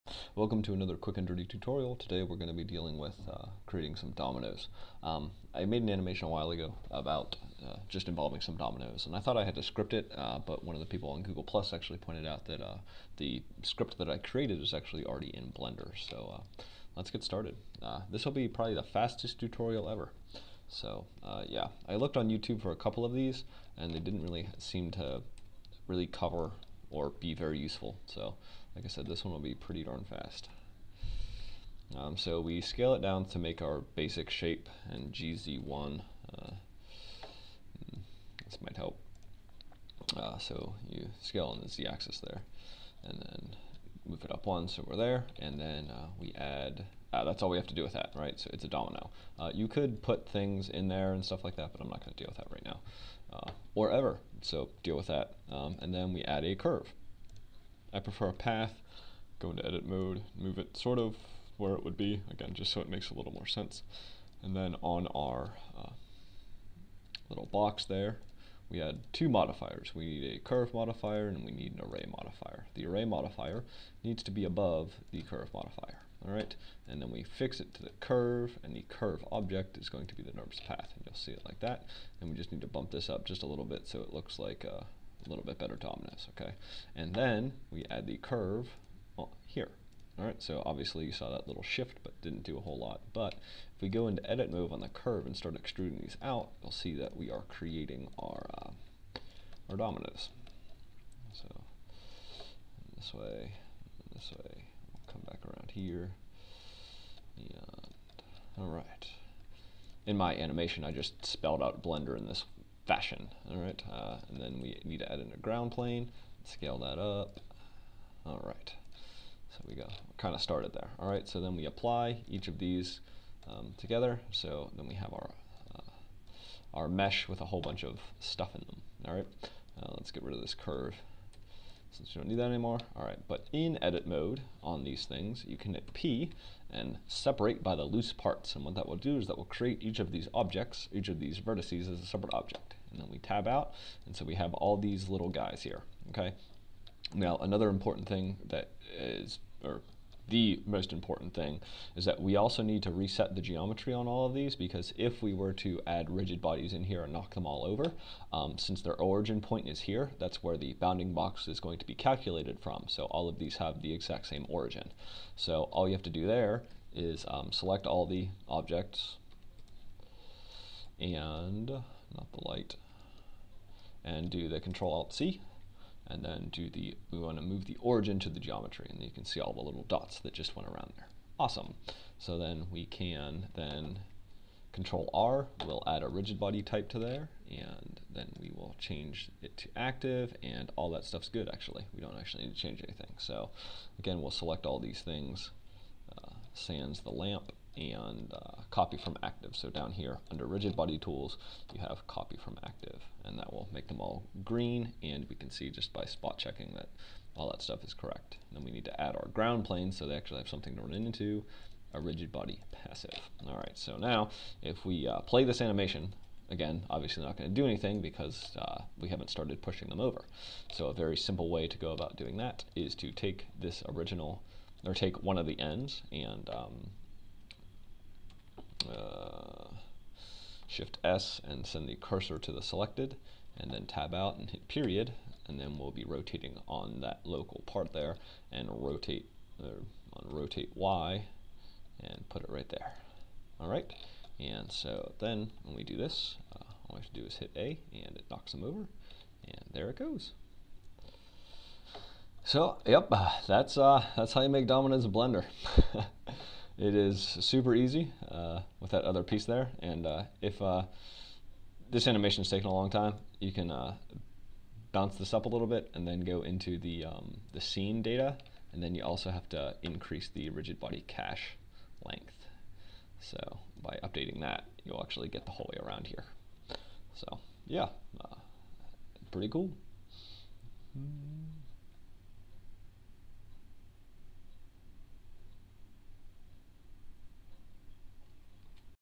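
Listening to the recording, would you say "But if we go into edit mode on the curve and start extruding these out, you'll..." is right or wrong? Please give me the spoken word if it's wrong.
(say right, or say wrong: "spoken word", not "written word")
right.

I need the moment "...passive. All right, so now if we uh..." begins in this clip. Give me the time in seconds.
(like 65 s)
212 s.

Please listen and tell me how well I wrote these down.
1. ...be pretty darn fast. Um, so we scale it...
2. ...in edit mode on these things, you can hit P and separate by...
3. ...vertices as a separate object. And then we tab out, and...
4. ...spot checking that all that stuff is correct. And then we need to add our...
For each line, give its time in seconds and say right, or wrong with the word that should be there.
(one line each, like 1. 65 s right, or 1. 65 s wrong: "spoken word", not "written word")
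1. 29 s right
2. 133 s right
3. 141 s right
4. 206 s right.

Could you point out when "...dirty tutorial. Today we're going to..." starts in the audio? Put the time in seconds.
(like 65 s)
1 s.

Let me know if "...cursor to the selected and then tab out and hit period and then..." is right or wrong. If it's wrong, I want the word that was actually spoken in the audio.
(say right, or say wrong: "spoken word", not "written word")
right.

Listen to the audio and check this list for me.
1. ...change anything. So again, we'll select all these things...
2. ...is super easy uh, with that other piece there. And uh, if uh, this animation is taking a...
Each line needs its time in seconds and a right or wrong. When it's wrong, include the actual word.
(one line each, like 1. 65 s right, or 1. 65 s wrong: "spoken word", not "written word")
1. 192 s right
2. 256 s right.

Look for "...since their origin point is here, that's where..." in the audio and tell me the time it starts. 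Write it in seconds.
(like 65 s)
158 s.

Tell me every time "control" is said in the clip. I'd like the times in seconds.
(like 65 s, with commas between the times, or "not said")
174 s, 184 s.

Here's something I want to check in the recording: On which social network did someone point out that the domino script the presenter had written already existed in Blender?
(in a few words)
Google Plus.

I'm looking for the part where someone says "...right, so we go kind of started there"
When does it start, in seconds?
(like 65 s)
118 s.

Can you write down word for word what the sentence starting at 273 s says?
So by updating that, you'll actually get the whole way around here.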